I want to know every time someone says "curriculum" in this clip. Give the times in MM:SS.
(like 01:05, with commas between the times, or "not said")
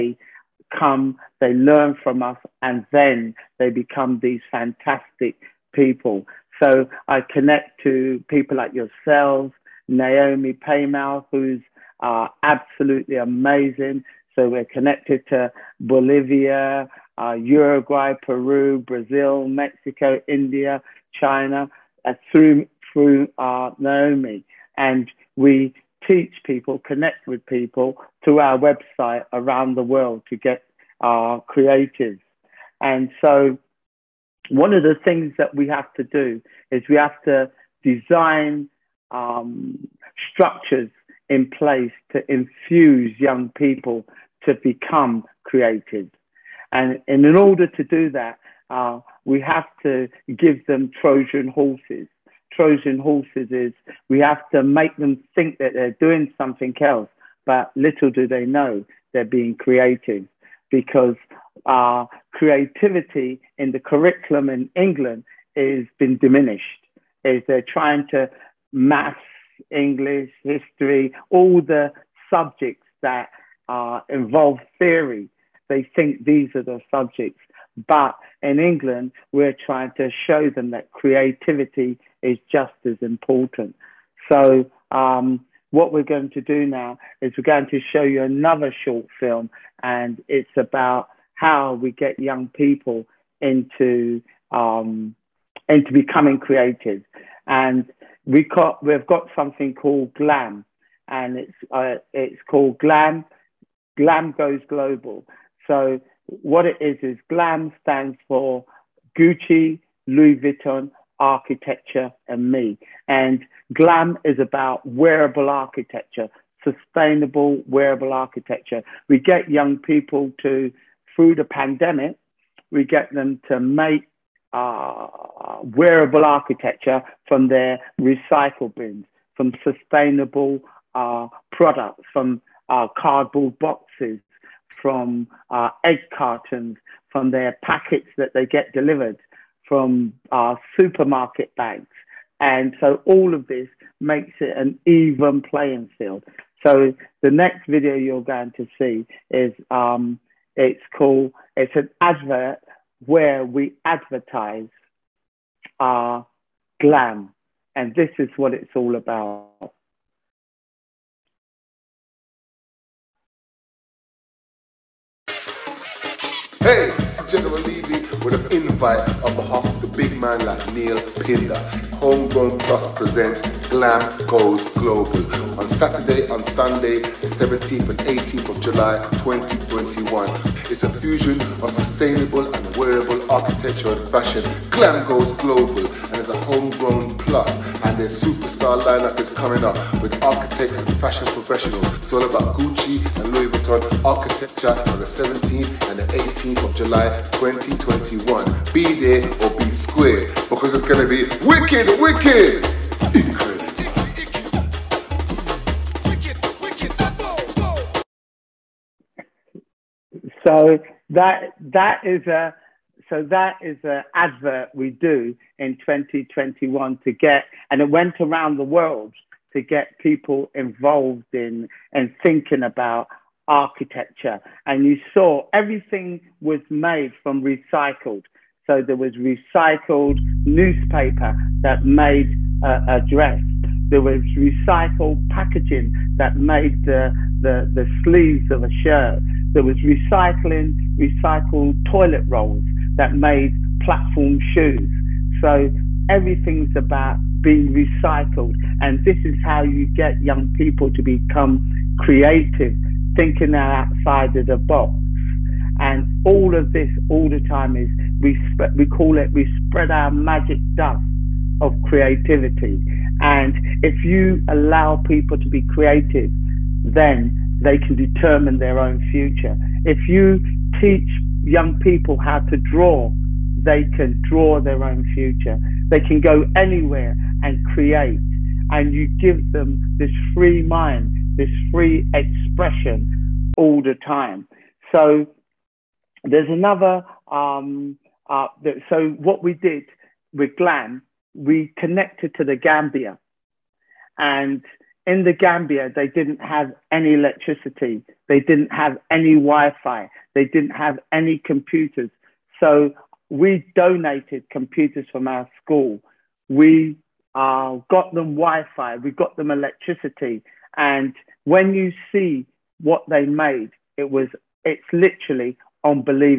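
01:03.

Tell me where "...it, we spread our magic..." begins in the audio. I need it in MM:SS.
04:19.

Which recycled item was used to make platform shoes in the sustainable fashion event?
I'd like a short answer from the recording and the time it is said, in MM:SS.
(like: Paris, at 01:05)
Toilet rolls, at 04:01.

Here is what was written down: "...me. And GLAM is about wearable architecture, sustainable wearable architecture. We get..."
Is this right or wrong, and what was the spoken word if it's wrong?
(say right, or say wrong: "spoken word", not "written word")
right.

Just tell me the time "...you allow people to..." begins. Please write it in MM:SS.
04:24.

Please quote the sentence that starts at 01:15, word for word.
They think these are the subjects but in England, we're trying to show them that creativity is just as important.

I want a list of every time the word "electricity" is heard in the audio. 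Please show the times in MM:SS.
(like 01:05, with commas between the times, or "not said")
04:57, 05:09.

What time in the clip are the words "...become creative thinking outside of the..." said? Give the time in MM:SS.
04:11.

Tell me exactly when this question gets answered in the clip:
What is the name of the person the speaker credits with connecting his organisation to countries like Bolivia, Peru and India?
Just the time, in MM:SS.
00:09.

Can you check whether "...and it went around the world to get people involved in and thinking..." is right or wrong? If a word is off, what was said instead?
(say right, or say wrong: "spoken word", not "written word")
right.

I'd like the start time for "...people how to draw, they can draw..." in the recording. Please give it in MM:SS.
04:31.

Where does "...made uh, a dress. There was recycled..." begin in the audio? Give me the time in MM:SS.
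03:51.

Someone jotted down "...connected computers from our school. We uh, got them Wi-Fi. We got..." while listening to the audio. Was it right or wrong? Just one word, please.
wrong.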